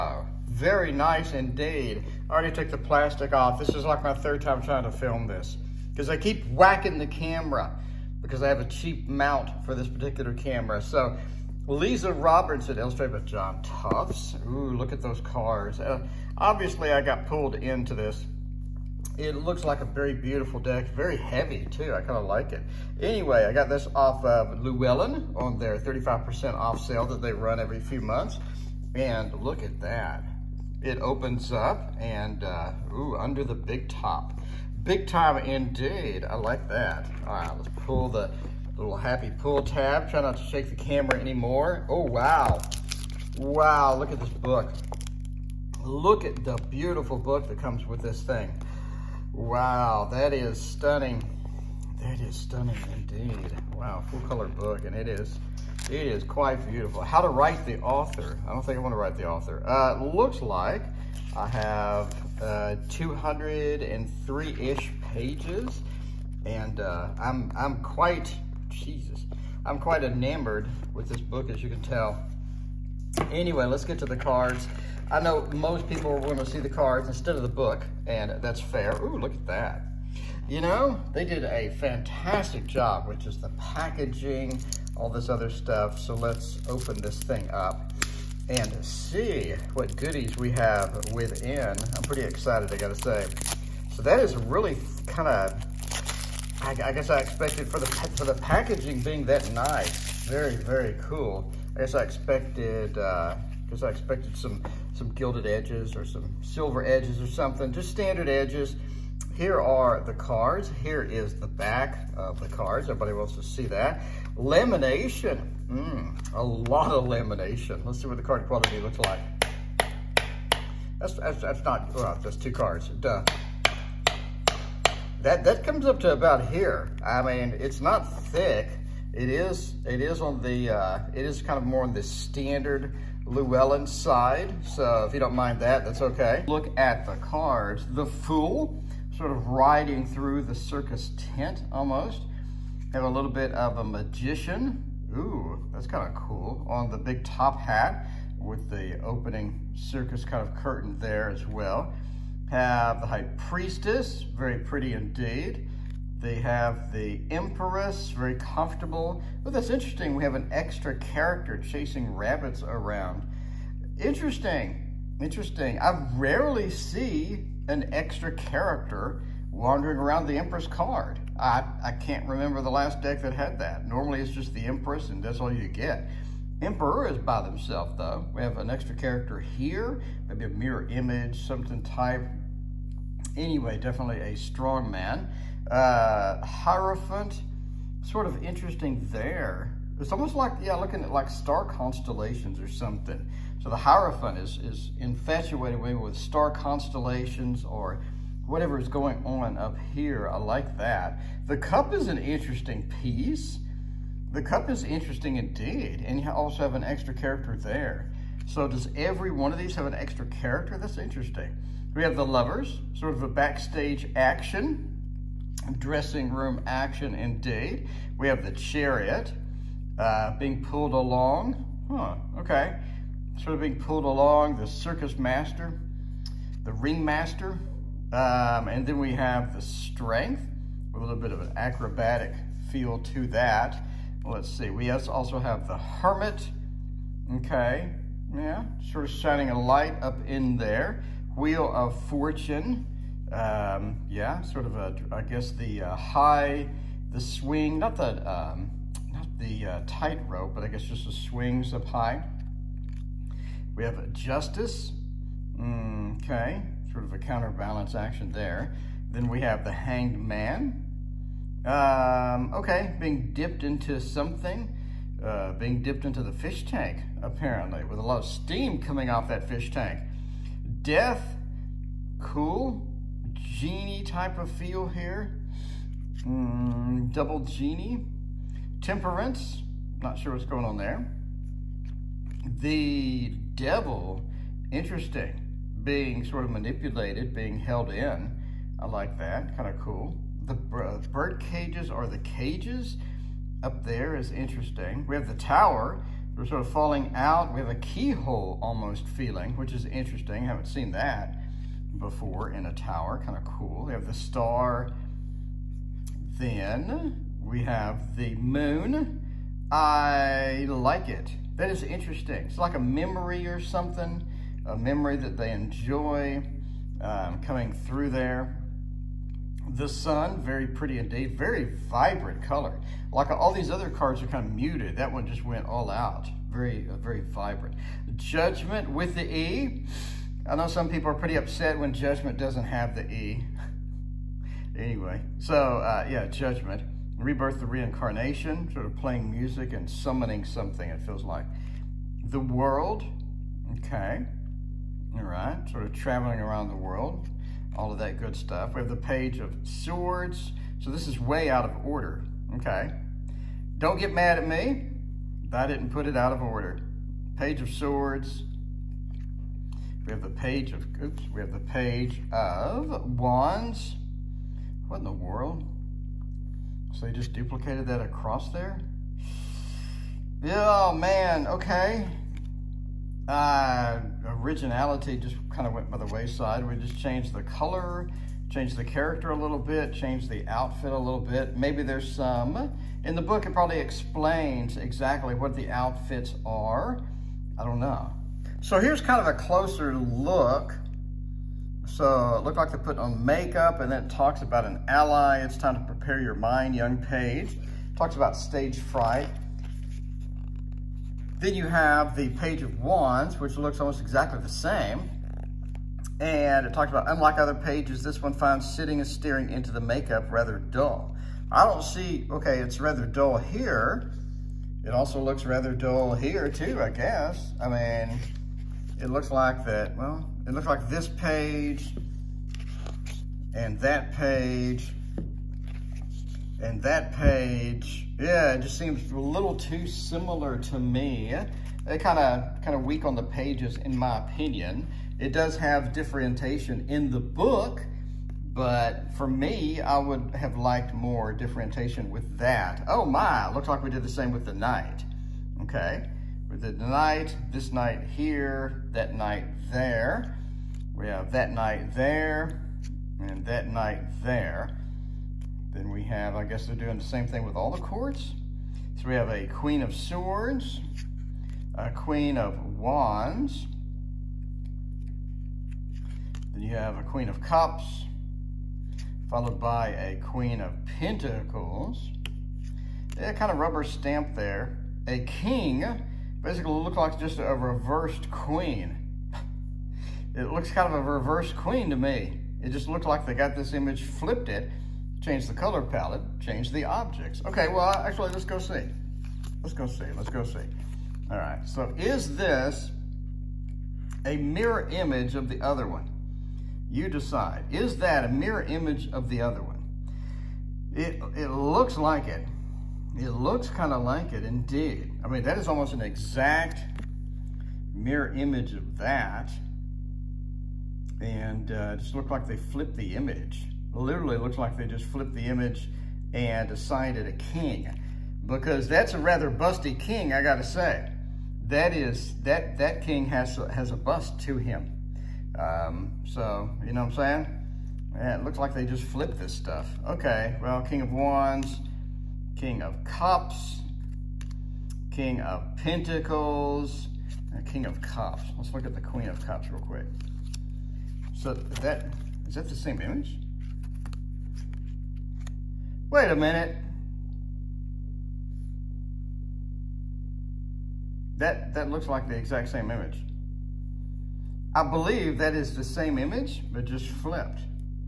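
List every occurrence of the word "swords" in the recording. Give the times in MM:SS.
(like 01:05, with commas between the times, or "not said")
05:49, 05:57, 07:39.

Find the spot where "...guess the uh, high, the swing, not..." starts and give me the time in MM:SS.
04:05.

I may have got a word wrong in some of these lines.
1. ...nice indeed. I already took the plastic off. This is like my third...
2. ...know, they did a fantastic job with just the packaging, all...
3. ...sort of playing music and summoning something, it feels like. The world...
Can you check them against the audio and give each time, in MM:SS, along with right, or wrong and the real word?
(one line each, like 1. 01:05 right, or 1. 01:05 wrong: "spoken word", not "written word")
1. 00:00 right
2. 01:20 right
3. 05:38 right.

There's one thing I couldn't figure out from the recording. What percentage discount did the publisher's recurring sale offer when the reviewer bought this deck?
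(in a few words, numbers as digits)
35%.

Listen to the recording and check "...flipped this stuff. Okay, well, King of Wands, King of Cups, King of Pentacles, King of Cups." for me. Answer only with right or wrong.
right.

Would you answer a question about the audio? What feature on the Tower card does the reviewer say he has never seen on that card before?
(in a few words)
keyhole.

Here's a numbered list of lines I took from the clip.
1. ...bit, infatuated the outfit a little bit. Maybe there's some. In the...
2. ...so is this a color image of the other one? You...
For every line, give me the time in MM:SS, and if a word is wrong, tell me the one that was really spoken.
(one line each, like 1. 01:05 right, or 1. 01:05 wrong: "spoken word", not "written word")
1. 06:19 wrong: "changed", not "infatuated"
2. 08:11 wrong: "mirror", not "color".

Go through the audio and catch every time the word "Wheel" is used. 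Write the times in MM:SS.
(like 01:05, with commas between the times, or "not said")
04:01.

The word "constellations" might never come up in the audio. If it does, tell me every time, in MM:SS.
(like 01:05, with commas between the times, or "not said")
03:11, 03:16.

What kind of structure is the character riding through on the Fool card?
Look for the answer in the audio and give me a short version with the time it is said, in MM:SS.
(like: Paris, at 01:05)
circus tent, at 02:20.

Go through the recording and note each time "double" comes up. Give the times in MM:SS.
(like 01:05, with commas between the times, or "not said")
04:37.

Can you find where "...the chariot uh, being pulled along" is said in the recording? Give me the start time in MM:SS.
03:38.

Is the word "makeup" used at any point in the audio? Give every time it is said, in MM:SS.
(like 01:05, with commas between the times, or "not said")
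06:33, 06:49.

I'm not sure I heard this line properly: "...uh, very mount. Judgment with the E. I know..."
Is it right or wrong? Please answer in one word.
wrong.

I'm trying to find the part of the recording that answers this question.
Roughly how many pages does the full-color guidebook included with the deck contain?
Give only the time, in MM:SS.
01:02.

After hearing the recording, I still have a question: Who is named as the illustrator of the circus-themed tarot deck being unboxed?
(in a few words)
John Tufts.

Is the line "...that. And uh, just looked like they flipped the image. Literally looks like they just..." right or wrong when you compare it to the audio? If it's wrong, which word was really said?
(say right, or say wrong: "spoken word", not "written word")
right.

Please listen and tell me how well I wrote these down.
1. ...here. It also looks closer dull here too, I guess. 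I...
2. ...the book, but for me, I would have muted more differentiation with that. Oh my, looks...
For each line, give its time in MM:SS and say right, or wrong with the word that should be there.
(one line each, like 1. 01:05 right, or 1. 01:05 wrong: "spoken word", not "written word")
1. 06:53 wrong: "rather", not "closer"
2. 07:17 wrong: "liked", not "muted".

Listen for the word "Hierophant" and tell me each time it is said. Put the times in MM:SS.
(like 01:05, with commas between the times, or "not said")
03:06, 03:13.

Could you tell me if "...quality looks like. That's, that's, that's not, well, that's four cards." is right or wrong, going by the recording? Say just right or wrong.
wrong.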